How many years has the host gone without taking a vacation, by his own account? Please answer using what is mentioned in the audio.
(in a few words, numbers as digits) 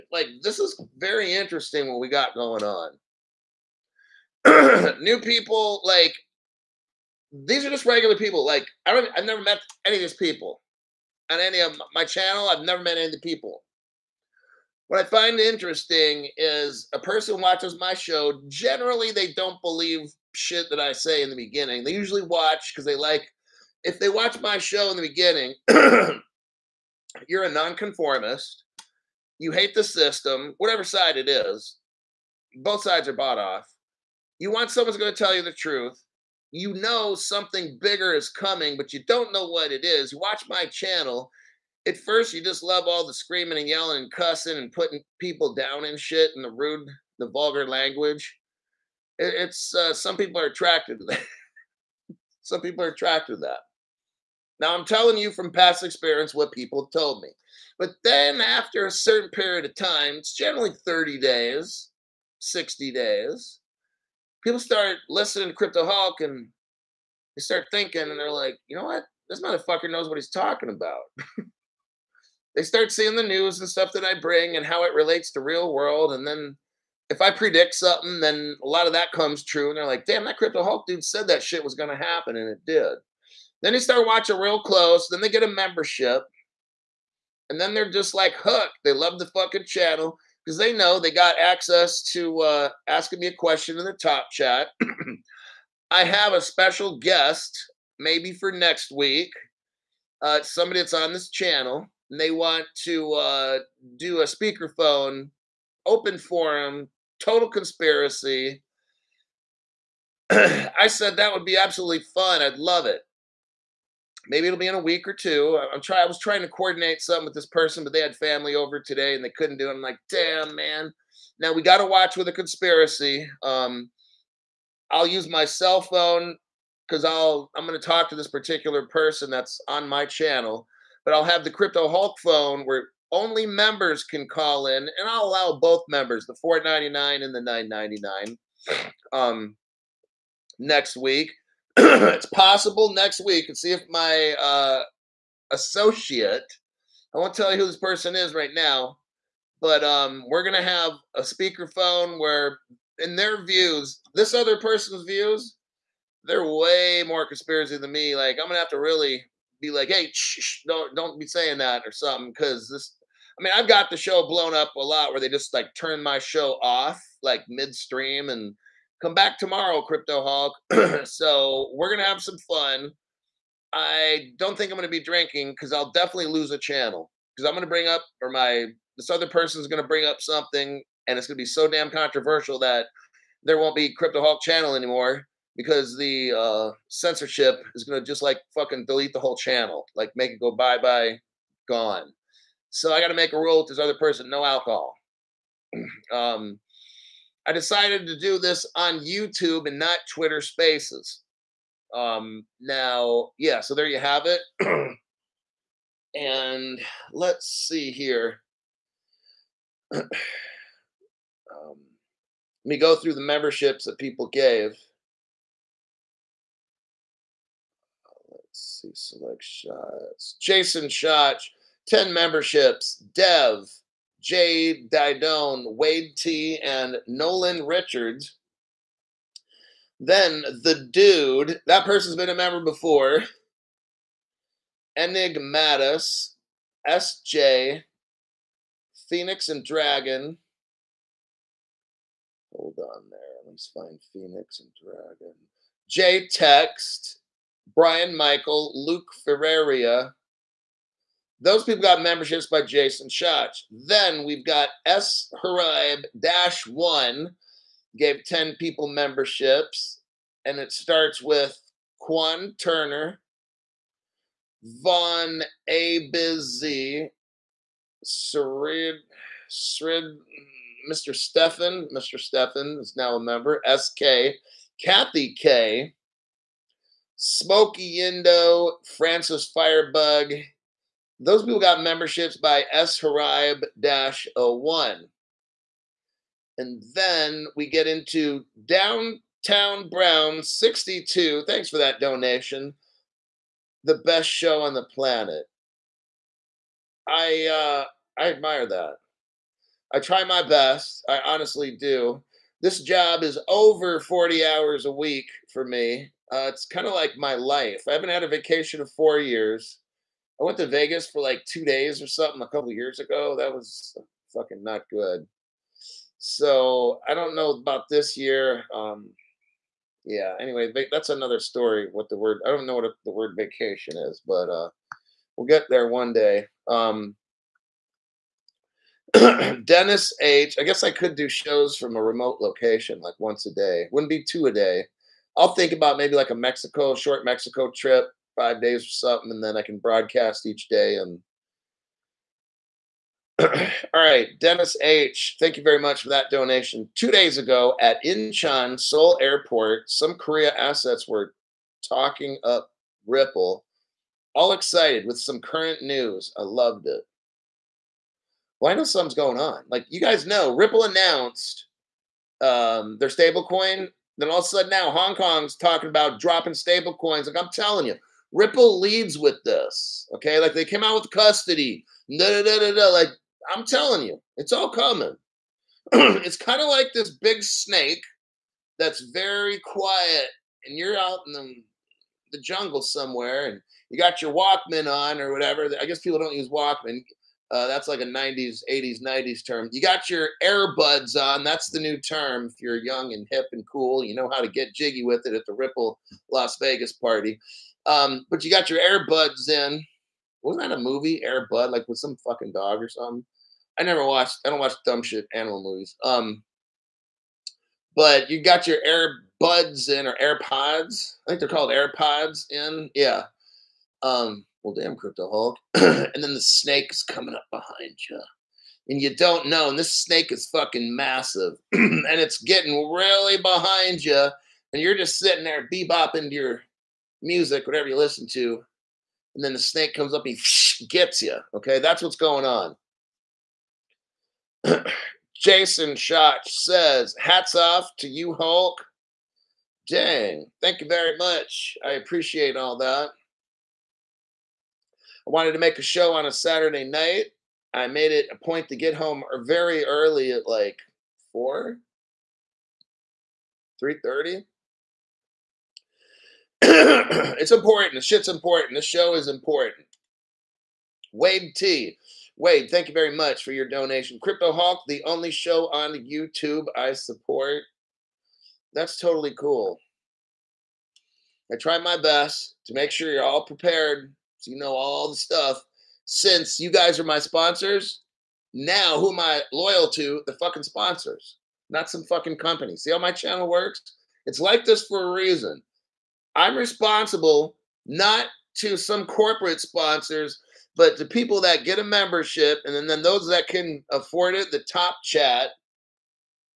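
4.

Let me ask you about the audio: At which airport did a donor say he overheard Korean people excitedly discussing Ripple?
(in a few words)
Incheon Seoul Airport.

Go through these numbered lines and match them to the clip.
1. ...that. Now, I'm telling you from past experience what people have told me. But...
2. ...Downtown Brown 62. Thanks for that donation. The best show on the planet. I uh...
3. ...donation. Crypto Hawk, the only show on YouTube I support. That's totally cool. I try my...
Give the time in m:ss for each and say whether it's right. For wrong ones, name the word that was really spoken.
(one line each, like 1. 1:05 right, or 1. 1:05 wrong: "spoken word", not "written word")
1. 0:53 right
2. 4:48 right
3. 7:43 right.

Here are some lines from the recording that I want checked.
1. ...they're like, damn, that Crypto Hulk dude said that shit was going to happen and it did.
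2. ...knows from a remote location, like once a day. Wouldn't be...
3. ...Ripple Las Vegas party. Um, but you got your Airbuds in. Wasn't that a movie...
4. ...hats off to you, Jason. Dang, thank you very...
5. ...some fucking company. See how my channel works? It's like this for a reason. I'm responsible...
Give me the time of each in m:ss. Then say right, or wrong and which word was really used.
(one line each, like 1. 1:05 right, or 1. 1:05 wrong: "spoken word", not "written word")
1. 1:19 right
2. 5:31 wrong: "shows", not "knows"
3. 6:35 right
4. 7:17 wrong: "Hulk", not "Jason"
5. 8:01 right.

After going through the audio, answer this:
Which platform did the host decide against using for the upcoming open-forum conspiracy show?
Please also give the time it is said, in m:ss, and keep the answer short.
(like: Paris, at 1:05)
Twitter Spaces, at 3:20.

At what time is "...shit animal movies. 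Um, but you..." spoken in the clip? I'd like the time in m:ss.
6:45.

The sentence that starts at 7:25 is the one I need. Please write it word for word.
I wanted to make a show on a Saturday night.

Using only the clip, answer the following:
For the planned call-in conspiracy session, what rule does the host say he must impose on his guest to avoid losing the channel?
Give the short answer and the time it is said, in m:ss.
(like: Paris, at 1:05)
no alcohol, at 3:14.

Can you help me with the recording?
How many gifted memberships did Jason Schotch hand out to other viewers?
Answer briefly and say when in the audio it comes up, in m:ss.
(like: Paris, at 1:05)
10, at 3:41.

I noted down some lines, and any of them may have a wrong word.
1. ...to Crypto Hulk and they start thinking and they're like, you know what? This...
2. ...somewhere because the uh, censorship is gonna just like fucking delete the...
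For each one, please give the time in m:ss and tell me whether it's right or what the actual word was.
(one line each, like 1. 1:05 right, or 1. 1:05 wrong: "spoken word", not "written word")
1. 1:05 right
2. 3:04 wrong: "anymore", not "somewhere".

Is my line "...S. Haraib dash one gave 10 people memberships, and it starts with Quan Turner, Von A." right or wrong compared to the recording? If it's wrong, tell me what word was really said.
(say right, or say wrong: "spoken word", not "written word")
right.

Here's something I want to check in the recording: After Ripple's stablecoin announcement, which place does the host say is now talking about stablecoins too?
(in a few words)
Hong Kong.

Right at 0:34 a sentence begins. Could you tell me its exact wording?
You want someone's going to tell you the truth.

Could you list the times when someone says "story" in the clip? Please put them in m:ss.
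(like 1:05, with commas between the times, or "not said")
5:21.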